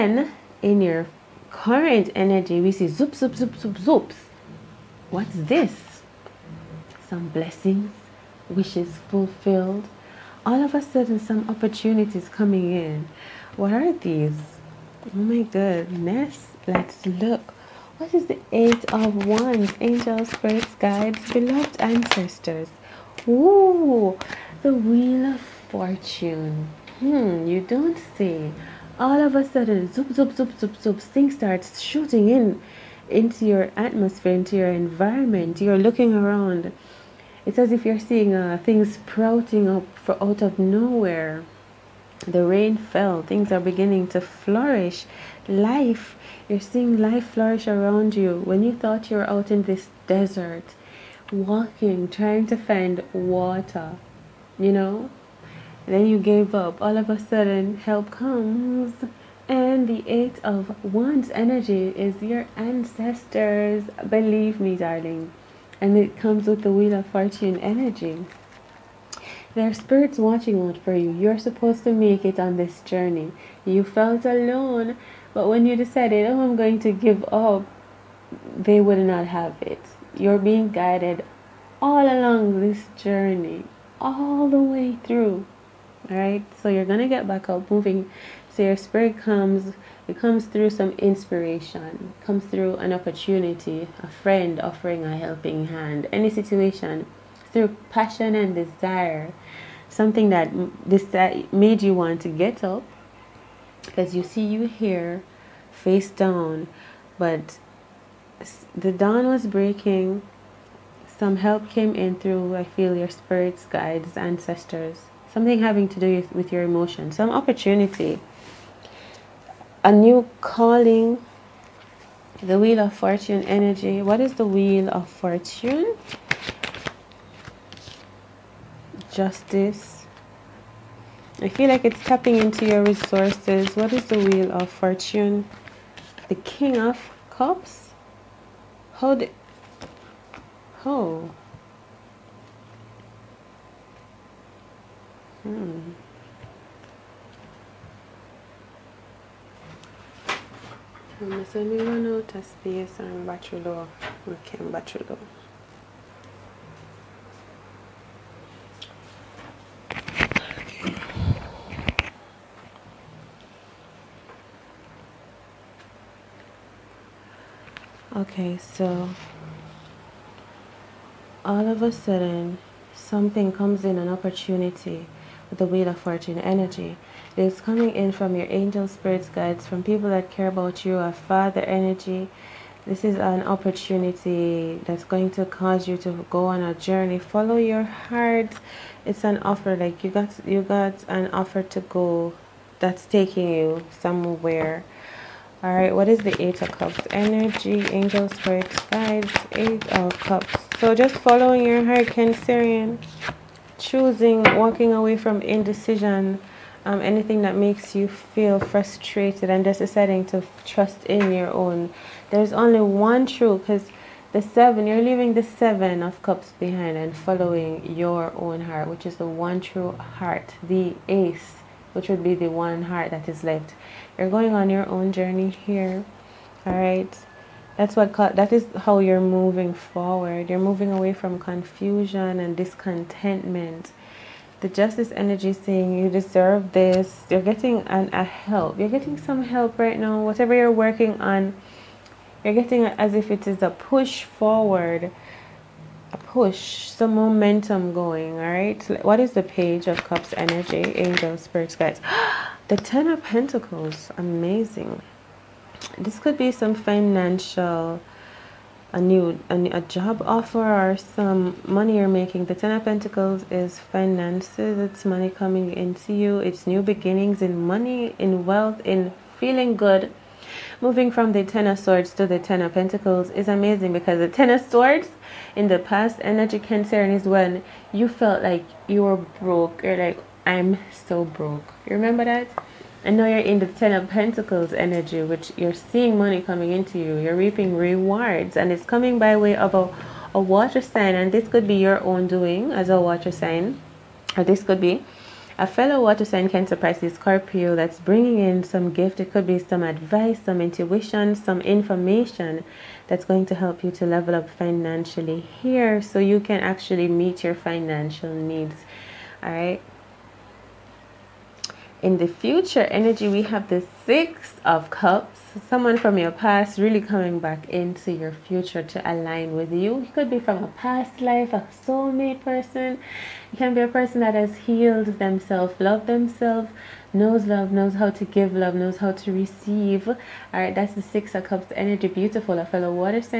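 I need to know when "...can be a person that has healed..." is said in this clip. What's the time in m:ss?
5:23.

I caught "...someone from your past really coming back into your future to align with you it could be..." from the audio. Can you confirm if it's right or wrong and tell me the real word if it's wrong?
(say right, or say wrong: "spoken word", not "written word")
right.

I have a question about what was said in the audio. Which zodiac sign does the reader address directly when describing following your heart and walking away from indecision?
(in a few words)
Cancerian.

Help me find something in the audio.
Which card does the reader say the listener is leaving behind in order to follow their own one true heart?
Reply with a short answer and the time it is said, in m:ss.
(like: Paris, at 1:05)
Seven of Cups, at 3:35.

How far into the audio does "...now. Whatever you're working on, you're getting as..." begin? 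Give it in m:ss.
3:59.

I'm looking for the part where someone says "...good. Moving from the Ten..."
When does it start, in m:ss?
4:29.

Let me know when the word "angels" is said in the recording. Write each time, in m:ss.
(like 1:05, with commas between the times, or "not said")
0:19, 2:58, 3:17, 4:10.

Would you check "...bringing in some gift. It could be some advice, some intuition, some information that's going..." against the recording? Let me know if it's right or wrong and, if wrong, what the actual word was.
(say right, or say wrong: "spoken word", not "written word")
right.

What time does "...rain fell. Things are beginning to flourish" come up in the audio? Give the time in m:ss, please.
0:42.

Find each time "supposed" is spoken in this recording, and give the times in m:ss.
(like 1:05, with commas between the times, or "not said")
1:11.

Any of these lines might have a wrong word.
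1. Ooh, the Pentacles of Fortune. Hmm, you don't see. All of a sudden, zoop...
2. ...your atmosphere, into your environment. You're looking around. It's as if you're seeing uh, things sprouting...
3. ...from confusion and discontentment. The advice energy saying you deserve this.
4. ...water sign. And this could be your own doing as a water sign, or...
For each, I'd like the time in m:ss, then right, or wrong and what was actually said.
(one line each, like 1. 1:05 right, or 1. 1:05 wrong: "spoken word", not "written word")
1. 0:23 wrong: "Wheel", not "Pentacles"
2. 0:33 right
3. 3:51 wrong: "justice", not "advice"
4. 4:50 right.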